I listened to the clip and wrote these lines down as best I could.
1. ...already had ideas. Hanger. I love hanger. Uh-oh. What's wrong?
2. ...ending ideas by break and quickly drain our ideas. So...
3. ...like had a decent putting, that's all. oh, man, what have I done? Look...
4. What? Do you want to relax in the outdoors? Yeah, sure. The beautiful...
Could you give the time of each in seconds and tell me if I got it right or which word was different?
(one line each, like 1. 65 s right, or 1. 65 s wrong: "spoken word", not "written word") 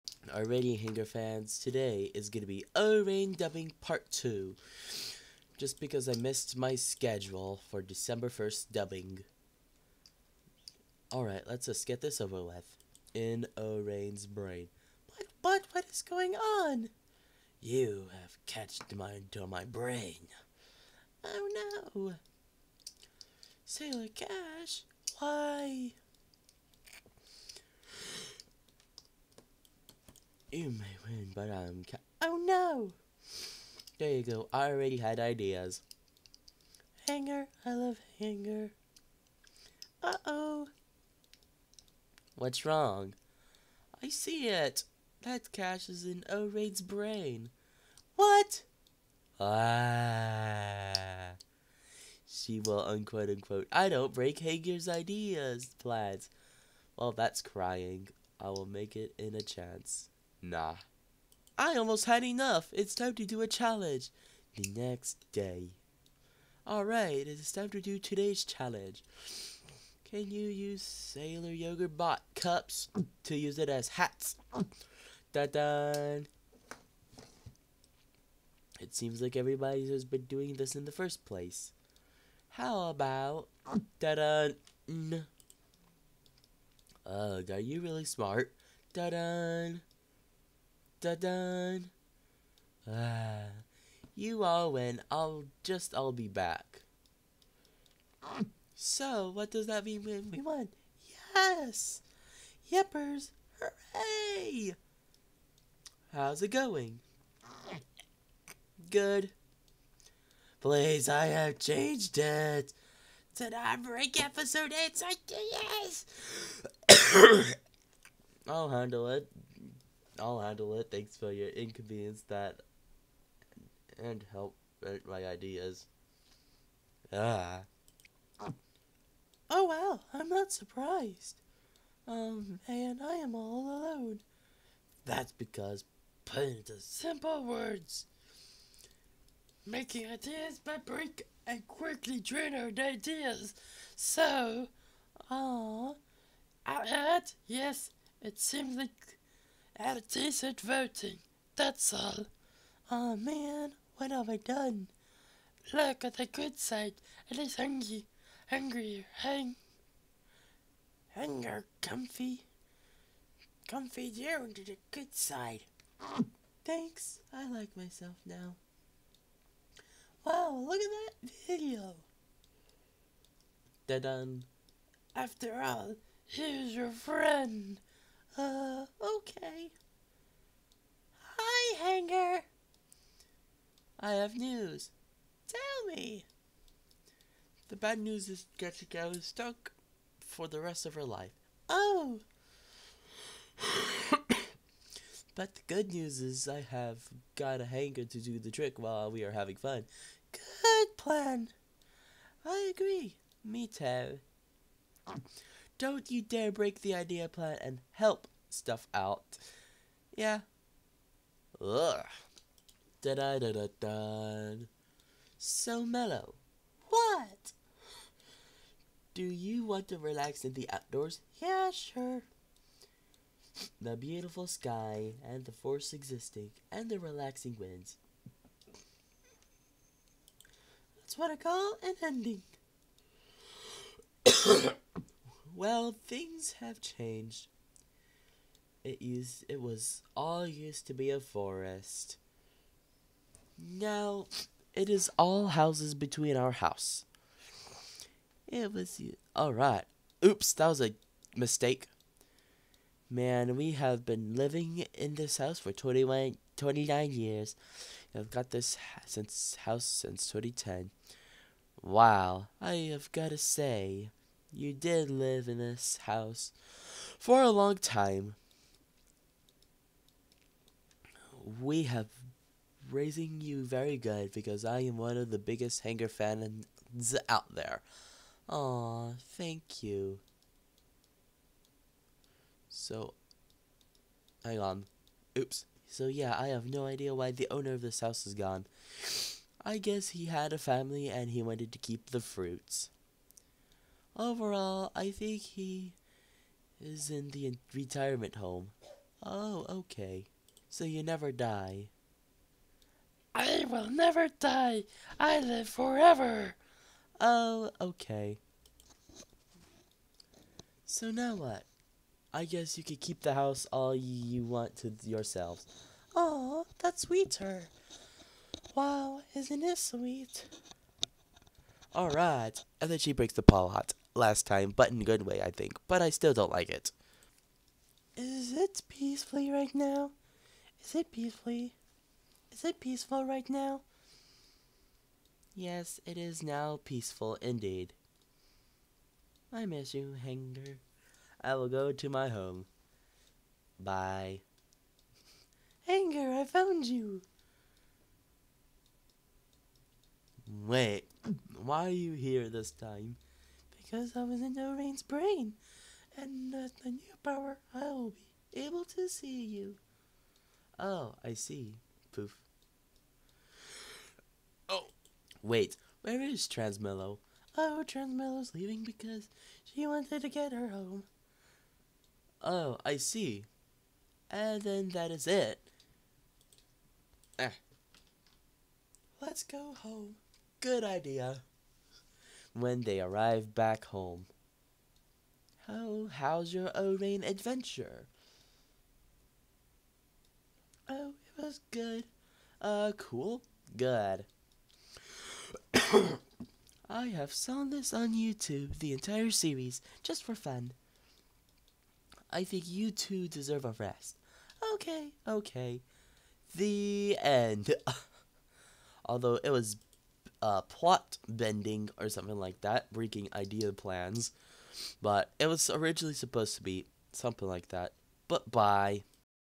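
1. 34 s right
2. 139 s wrong: "making", not "ending"
3. 148 s wrong: "voting", not "putting"
4. 216 s right.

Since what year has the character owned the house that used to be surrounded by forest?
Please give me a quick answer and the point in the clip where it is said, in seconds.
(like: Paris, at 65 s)
2010, at 260 s.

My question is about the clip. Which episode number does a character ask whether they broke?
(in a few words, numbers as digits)
8.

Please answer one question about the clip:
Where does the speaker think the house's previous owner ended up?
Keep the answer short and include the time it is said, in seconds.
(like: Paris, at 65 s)
retirement home, at 297 s.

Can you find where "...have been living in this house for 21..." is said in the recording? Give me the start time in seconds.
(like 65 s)
253 s.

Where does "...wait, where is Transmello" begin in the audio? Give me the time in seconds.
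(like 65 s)
365 s.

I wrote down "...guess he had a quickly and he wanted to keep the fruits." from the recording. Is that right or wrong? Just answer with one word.
wrong.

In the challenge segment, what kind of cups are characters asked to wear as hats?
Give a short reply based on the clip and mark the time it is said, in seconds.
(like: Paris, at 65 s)
Sailor Yogurt Bot cups, at 70 s.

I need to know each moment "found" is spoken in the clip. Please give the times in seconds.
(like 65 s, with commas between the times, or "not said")
346 s.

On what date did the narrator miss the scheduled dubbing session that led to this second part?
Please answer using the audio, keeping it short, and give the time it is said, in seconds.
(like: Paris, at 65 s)
December 1st, at 7 s.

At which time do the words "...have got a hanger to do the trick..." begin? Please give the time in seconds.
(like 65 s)
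196 s.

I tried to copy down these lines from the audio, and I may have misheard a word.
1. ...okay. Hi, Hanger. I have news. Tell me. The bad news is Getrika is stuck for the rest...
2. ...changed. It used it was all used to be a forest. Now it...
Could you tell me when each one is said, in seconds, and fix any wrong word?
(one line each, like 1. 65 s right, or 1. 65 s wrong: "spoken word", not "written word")
1. 179 s right
2. 236 s right.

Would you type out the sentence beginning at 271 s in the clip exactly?
We have raising you very good because I am one of the biggest hanger fans out there.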